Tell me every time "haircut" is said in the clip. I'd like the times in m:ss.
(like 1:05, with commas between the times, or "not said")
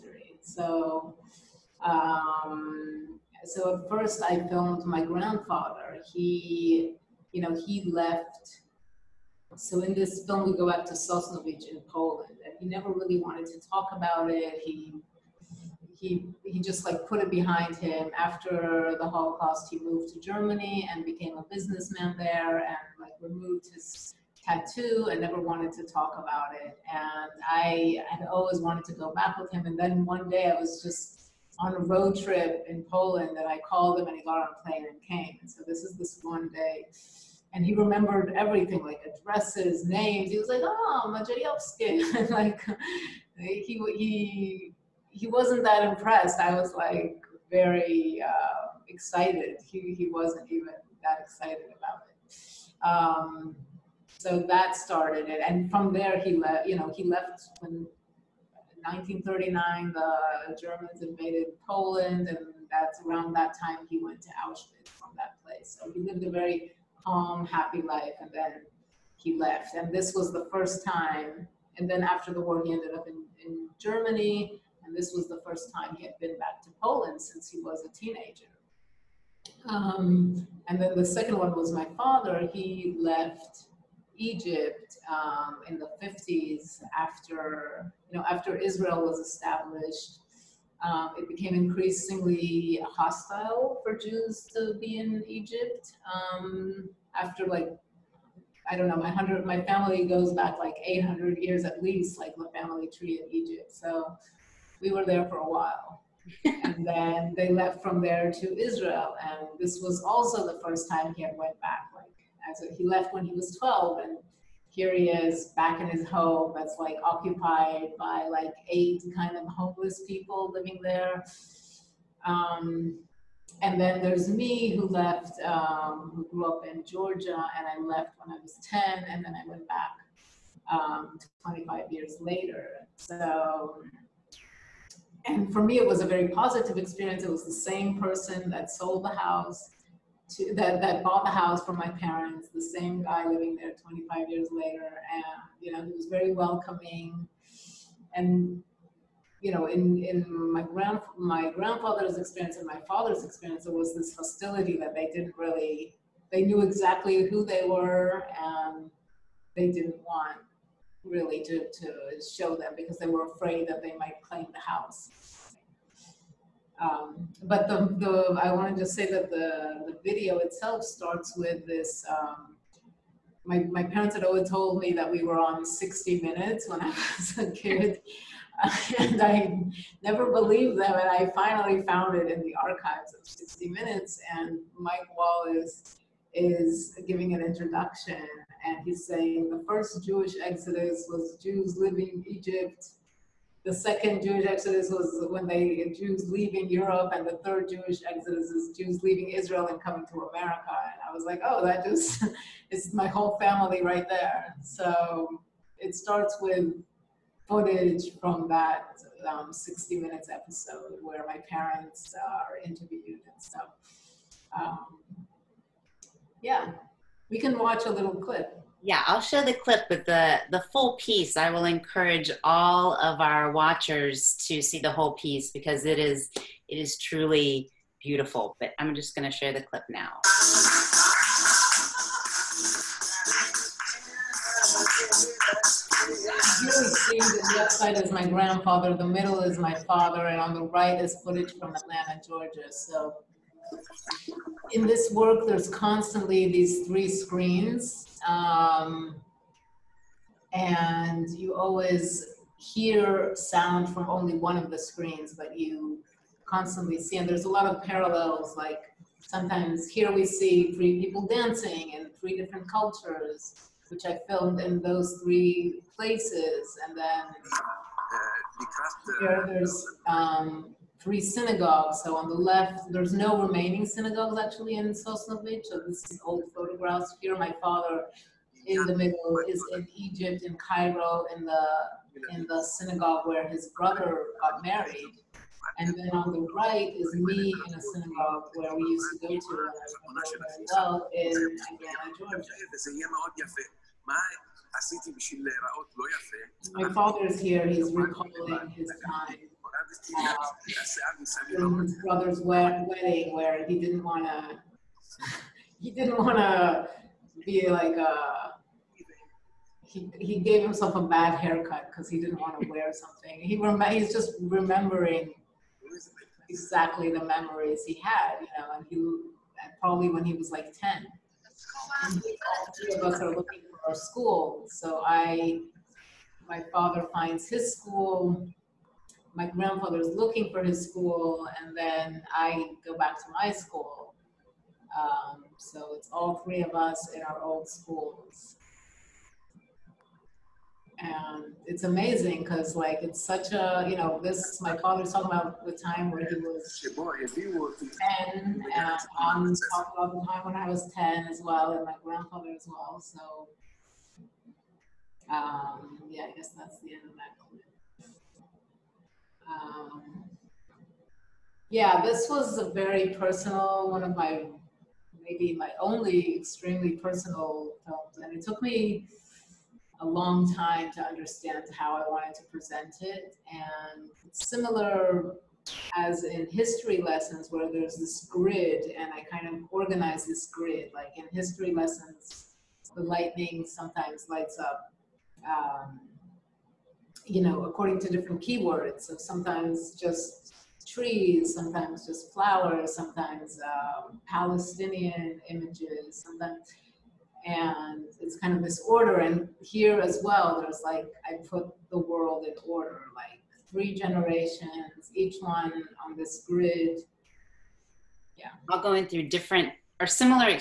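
5:11.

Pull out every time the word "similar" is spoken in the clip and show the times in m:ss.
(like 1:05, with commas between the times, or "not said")
6:14, 6:50.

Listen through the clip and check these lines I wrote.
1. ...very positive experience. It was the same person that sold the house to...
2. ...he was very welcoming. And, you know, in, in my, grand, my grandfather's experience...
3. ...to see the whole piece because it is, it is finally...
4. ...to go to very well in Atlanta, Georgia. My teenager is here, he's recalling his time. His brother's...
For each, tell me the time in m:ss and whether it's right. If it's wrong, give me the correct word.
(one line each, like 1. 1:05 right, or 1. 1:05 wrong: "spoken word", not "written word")
1. 2:16 right
2. 2:25 right
3. 3:44 wrong: "truly", not "finally"
4. 4:49 wrong: "father", not "teenager".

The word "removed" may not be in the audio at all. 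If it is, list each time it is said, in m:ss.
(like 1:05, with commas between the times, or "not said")
0:23.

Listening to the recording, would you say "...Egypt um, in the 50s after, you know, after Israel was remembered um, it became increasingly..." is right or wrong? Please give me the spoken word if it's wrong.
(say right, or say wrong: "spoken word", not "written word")
wrong: "established", not "remembered".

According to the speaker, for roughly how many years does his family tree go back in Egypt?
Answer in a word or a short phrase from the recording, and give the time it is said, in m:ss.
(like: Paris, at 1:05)
800 years, at 1:40.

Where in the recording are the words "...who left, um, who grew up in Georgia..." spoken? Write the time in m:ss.
2:04.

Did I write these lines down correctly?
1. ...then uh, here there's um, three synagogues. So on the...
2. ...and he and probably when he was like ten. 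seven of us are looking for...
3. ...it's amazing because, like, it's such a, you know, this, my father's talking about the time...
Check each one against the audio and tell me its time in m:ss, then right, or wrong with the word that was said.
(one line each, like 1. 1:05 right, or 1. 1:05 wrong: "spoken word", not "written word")
1. 4:26 right
2. 5:18 wrong: "three", not "seven"
3. 5:41 right.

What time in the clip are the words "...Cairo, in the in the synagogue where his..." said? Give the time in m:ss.
4:40.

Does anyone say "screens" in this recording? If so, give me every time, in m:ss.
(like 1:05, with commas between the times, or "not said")
4:07, 4:14.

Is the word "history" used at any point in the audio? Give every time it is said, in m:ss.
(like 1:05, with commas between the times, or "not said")
6:16, 6:21.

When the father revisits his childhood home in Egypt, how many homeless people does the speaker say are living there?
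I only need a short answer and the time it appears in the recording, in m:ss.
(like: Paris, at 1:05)
8, at 1:58.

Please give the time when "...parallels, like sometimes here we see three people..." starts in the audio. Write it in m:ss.
4:17.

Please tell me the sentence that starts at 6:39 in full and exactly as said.
And here as well, there's like, I put the world in order, like three generations, each one on this grid.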